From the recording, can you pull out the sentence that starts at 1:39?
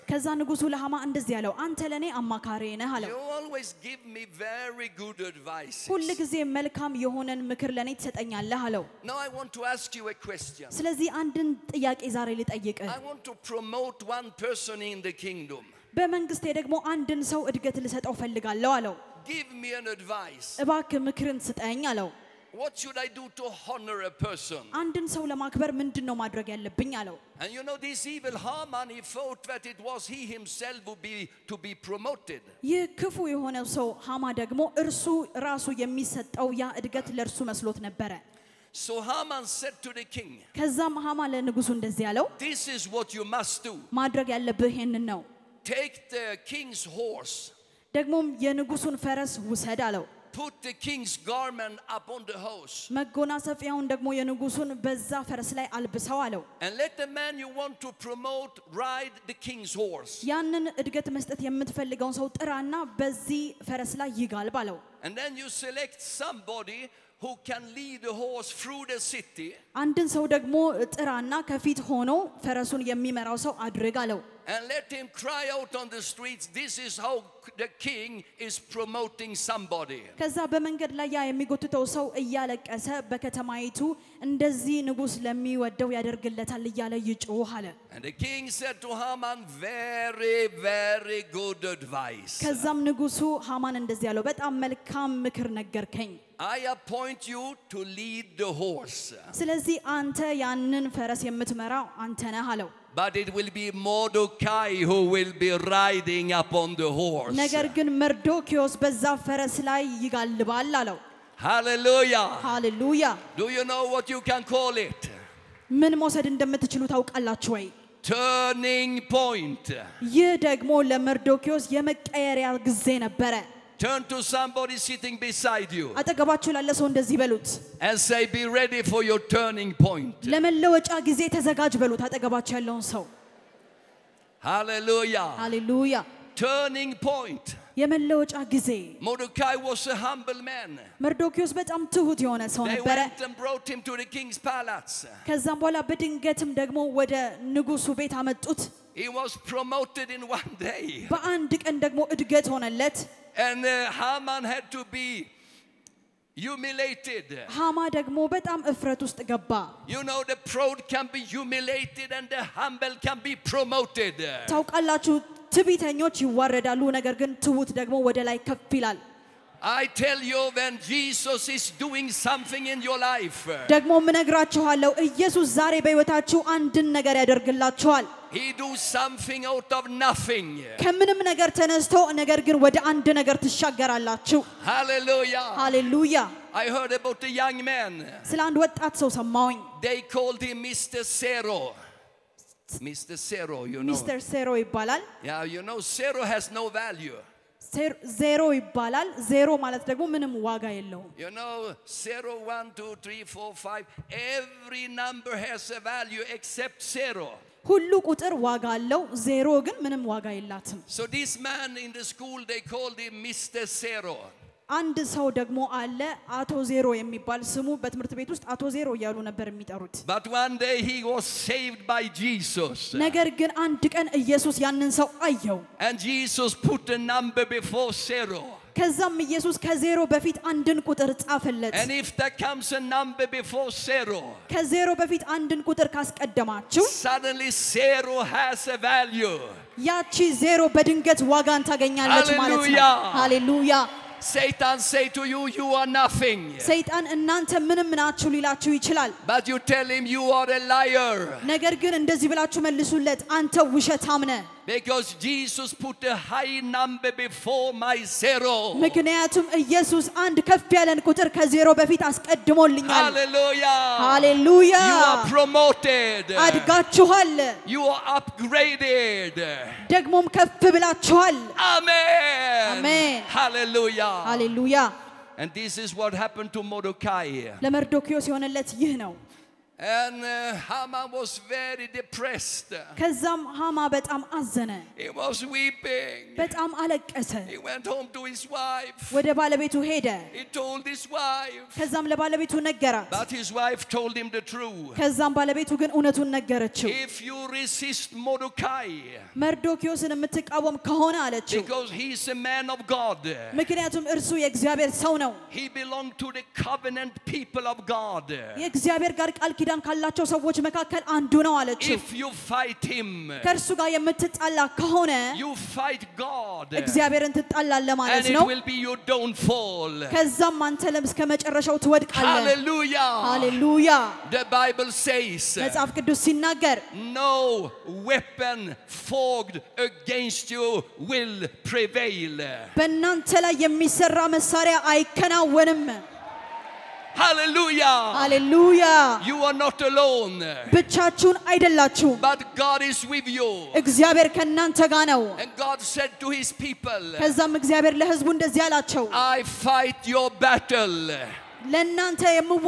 ስለዚህ ስለዚህ አንተ ያንን ፈረስ የምትመራው አንተ ነህ አለው። But it will be Mordecai who will be riding upon the horse.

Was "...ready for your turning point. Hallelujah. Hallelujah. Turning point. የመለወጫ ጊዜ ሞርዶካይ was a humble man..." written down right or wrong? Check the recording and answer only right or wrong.
right.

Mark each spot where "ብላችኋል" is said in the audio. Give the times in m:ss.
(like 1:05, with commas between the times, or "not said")
4:30.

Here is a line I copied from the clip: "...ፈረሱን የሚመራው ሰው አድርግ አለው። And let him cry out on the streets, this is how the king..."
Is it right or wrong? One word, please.
right.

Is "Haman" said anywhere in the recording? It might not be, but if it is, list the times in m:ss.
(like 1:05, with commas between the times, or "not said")
0:28, 0:38, 1:29, 2:33, 4:40.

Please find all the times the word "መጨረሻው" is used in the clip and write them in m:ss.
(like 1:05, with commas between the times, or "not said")
5:21.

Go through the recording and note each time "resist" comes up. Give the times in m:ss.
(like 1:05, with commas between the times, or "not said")
4:57.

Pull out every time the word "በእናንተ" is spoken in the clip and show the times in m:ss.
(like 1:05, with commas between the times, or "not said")
5:32.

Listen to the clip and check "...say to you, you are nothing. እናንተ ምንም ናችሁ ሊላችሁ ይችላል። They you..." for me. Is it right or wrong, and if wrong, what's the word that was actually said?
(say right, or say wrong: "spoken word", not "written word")
wrong: "But", not "They".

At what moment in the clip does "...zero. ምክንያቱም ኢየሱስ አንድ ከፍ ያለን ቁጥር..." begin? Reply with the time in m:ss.
4:18.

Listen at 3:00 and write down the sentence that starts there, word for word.
ከምንም ነገር ተነስቶ ነገር ግን ወደ አንድ ነገር ትሻገራላችሁ። ሃሌሉያ ሃሌሉያ። I heard about a young man.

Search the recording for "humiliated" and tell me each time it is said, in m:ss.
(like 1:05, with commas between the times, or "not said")
2:36, 2:41.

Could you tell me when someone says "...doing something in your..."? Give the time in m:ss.
2:51.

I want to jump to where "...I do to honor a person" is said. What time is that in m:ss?
0:22.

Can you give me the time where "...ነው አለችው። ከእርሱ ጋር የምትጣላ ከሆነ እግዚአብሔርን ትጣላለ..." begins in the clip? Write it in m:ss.
5:11.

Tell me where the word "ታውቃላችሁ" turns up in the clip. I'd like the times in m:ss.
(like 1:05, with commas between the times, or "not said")
1:56, 2:44.